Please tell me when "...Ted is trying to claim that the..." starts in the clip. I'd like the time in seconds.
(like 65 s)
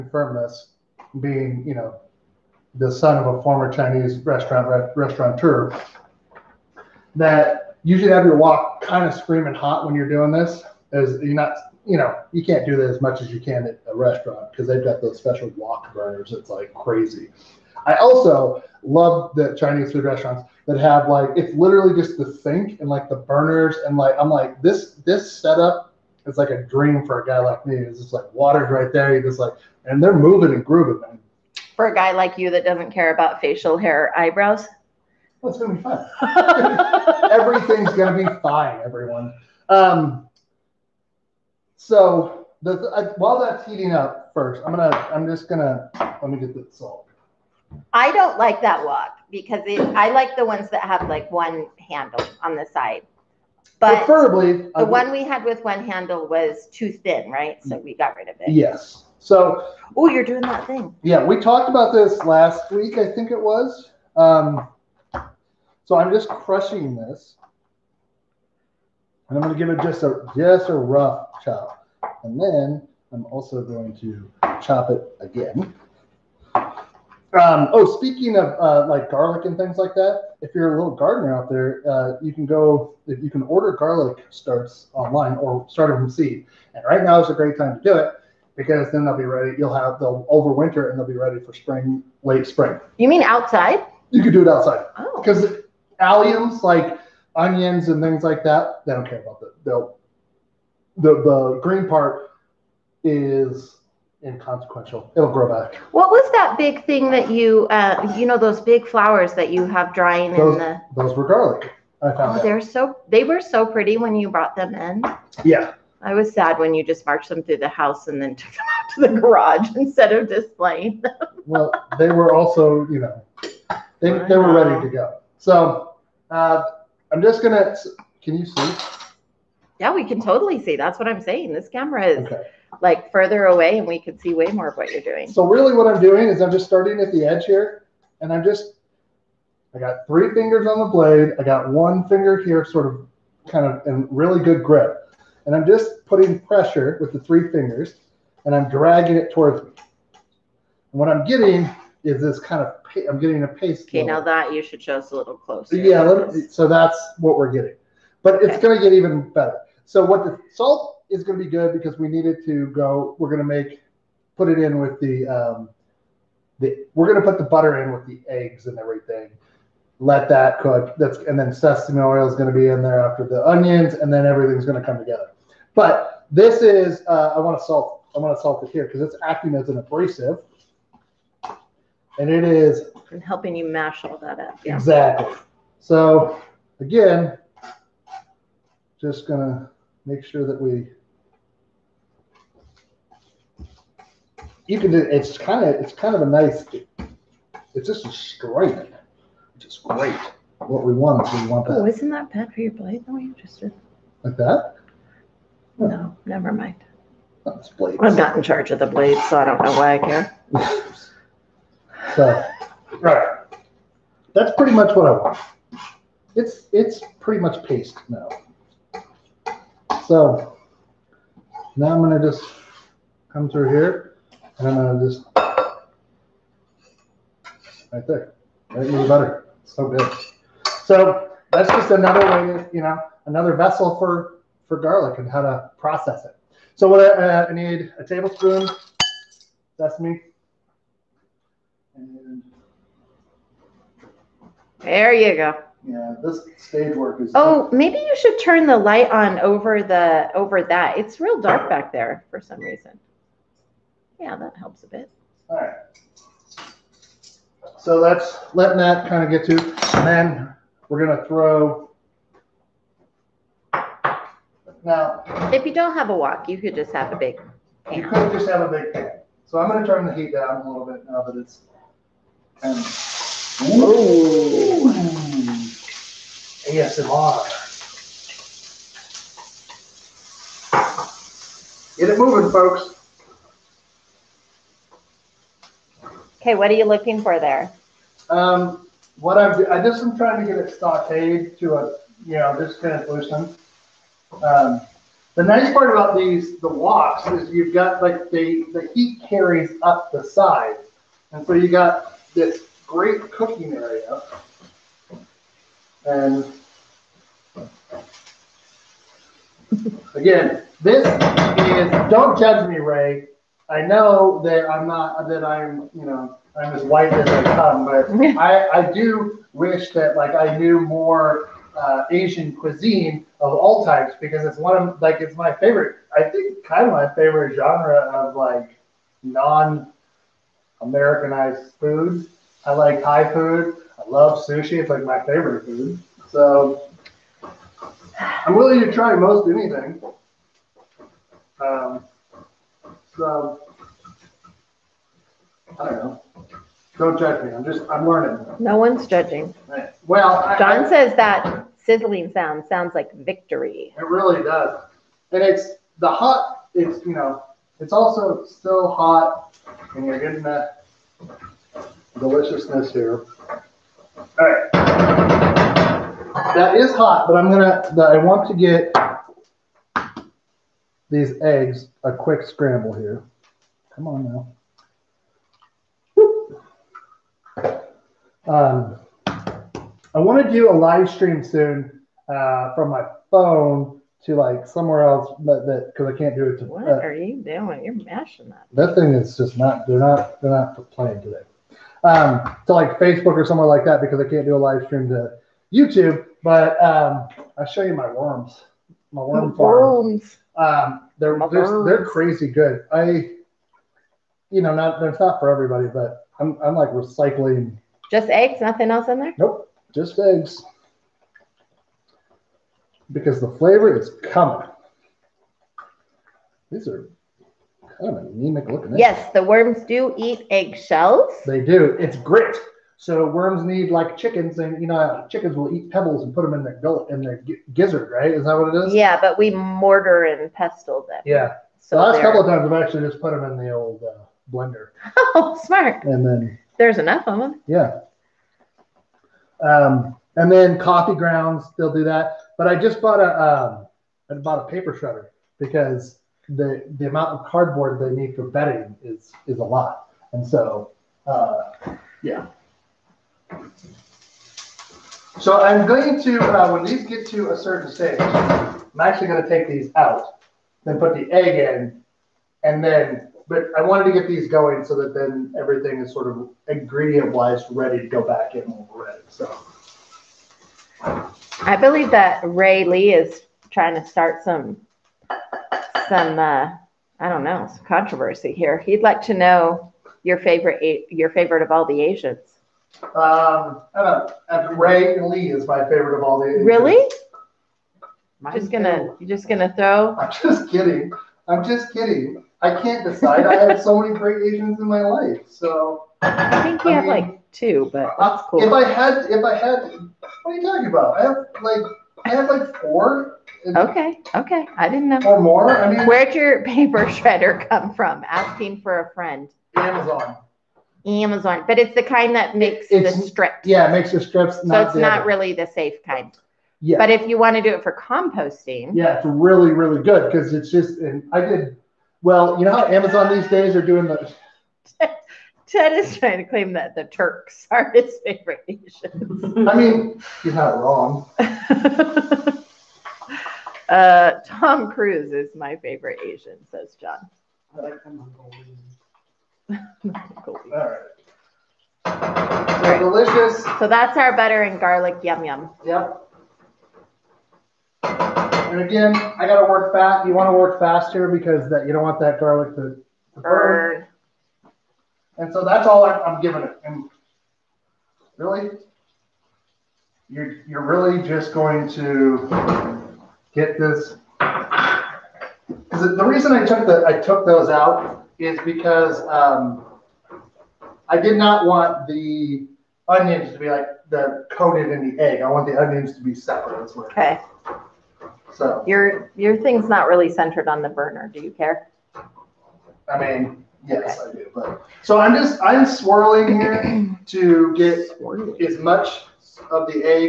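525 s.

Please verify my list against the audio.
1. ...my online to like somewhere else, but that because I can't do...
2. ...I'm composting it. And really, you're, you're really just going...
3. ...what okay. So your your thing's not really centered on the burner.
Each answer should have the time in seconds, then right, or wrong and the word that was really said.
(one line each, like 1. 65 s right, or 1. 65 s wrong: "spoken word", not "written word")
1. 382 s wrong: "phone", not "online"
2. 556 s wrong: "giving", not "composting"
3. 576 s right.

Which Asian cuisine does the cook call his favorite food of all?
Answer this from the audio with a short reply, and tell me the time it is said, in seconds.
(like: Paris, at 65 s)
sushi, at 334 s.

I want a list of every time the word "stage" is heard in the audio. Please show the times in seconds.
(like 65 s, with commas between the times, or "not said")
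246 s, 457 s.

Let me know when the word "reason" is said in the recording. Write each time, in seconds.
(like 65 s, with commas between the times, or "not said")
252 s, 566 s.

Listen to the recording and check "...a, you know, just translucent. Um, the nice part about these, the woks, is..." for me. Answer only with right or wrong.
right.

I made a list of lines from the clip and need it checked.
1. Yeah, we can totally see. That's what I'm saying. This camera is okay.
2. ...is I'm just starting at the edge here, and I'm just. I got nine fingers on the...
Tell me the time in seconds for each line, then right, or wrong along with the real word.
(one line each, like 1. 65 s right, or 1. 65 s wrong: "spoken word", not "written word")
1. 129 s right
2. 136 s wrong: "three", not "nine".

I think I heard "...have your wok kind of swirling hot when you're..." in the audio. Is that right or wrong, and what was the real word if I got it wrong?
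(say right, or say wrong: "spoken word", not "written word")
wrong: "screaming", not "swirling".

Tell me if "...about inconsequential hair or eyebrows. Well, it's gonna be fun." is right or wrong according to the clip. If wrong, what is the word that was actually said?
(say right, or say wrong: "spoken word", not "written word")
wrong: "facial", not "inconsequential".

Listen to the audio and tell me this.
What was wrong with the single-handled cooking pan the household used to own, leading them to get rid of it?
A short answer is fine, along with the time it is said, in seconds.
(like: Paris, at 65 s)
too thin, at 56 s.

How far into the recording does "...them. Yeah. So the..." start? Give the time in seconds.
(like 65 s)
431 s.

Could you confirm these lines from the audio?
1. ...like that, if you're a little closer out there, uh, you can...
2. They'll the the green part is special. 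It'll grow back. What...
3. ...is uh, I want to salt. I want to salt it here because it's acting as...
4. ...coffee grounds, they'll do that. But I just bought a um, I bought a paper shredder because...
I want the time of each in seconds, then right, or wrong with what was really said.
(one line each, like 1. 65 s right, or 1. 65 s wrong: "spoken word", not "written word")
1. 79 s wrong: "gardener", not "closer"
2. 99 s wrong: "inconsequential", not "special"
3. 176 s right
4. 440 s right.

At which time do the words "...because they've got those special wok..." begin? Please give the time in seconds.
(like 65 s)
14 s.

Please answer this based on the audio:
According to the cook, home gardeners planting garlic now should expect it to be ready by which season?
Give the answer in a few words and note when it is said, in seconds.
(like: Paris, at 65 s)
late spring, at 92 s.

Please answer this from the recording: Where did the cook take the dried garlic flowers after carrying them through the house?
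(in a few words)
the garage.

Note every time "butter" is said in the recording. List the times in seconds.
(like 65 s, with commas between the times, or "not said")
167 s, 229 s, 544 s.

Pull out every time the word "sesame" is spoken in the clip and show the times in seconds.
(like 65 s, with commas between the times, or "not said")
171 s, 239 s.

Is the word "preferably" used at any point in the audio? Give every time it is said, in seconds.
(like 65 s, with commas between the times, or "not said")
54 s.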